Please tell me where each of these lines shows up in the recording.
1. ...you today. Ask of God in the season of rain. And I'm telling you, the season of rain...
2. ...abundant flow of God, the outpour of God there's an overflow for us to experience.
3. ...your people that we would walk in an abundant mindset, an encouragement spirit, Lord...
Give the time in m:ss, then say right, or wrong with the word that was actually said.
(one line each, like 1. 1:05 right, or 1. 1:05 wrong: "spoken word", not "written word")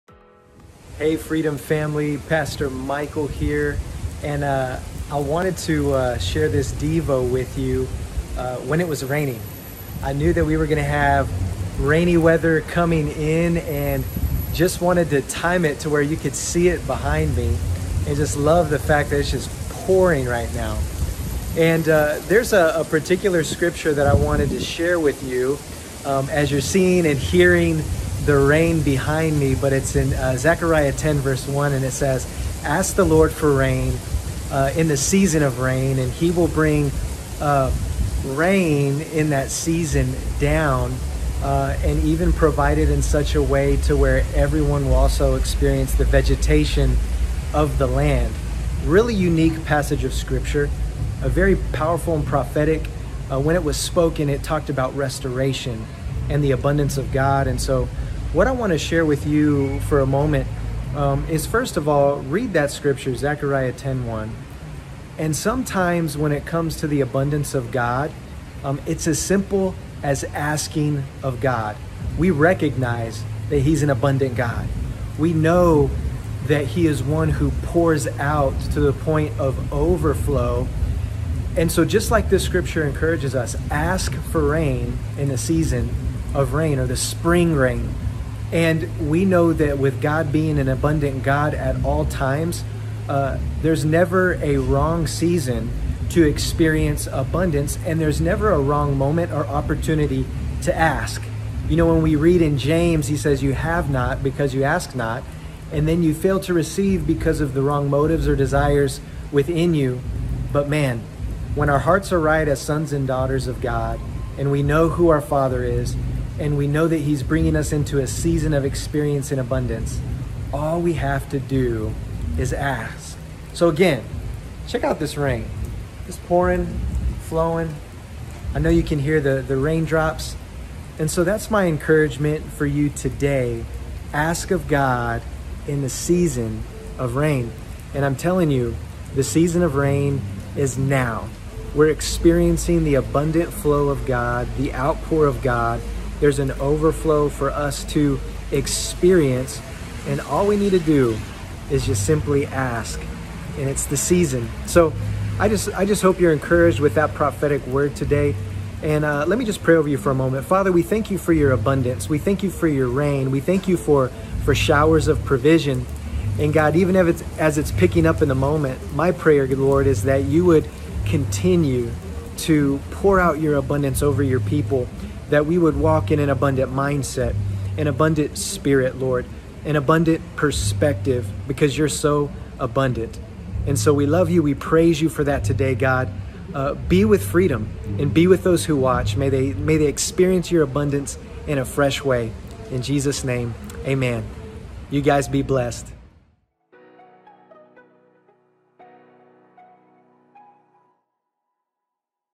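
1. 2:12 right
2. 2:22 right
3. 2:54 wrong: "abundant", not "encouragement".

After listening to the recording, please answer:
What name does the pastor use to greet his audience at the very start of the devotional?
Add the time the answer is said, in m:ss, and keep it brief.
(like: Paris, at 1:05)
Freedom Family, at 0:01.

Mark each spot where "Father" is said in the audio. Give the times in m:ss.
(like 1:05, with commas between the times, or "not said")
1:55, 2:40.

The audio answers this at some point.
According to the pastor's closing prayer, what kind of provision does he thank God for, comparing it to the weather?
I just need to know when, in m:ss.
2:44.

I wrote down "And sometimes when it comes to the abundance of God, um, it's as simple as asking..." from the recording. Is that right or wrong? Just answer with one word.
right.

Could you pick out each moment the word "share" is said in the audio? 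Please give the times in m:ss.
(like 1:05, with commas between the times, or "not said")
0:06, 0:24, 0:58.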